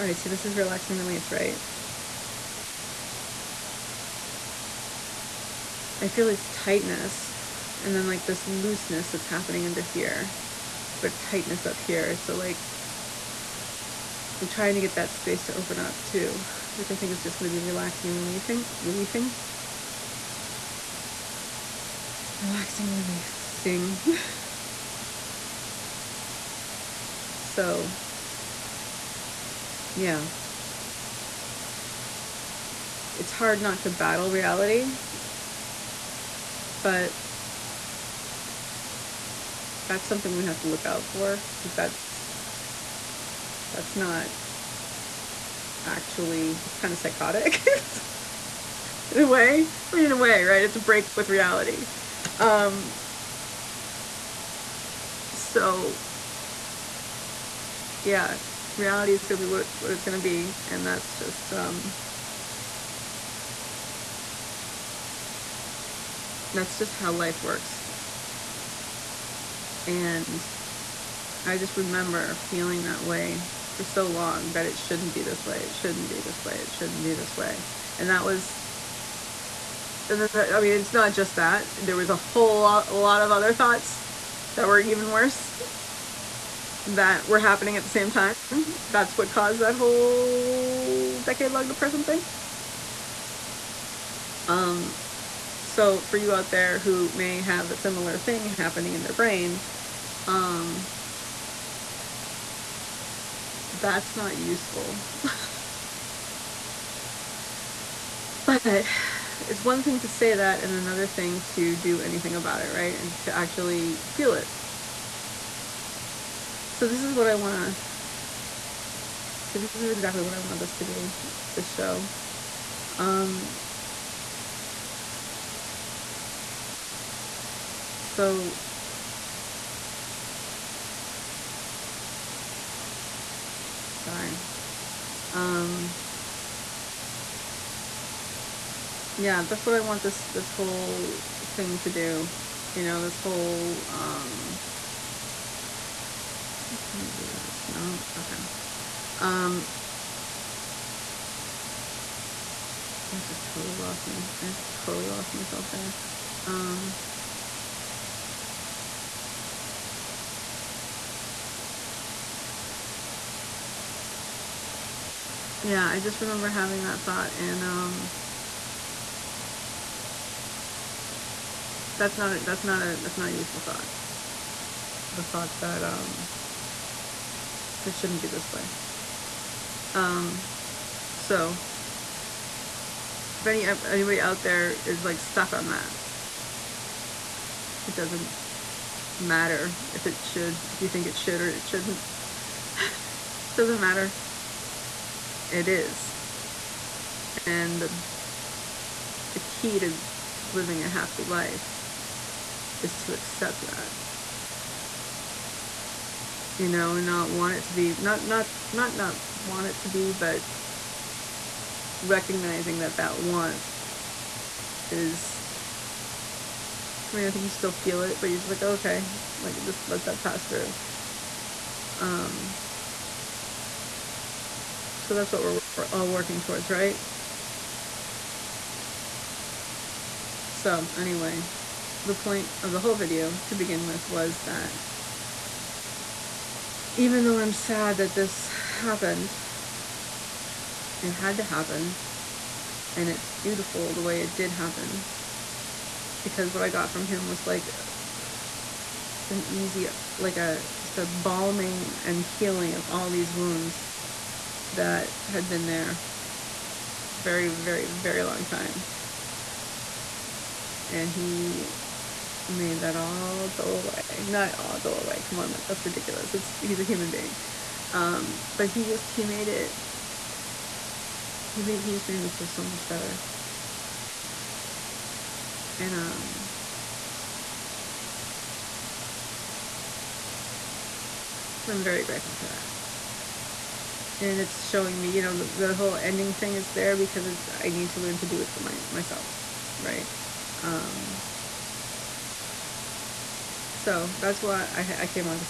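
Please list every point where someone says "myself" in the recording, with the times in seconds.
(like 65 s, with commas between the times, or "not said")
155 s, 288 s.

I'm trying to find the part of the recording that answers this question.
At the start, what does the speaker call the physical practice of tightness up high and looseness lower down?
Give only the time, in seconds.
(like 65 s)
0 s.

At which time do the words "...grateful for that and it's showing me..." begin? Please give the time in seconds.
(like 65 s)
282 s.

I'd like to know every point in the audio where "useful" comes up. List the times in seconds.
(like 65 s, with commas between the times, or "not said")
104 s, 173 s.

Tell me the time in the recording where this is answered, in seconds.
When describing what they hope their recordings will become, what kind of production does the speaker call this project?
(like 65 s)
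121 s.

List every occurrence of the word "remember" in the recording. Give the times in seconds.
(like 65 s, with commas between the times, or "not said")
71 s, 166 s.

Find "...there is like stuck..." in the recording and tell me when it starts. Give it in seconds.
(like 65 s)
184 s.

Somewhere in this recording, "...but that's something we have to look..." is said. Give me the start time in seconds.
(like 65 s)
36 s.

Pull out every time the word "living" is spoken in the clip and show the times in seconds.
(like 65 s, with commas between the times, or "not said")
200 s.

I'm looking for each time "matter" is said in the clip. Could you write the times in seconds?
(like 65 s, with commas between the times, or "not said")
189 s, 193 s.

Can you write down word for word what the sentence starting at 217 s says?
I mean, I think you still feel it, but you're just like, oh, okay, like just let that pass through.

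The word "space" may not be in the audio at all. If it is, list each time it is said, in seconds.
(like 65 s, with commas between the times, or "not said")
15 s.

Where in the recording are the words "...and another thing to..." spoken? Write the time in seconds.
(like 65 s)
110 s.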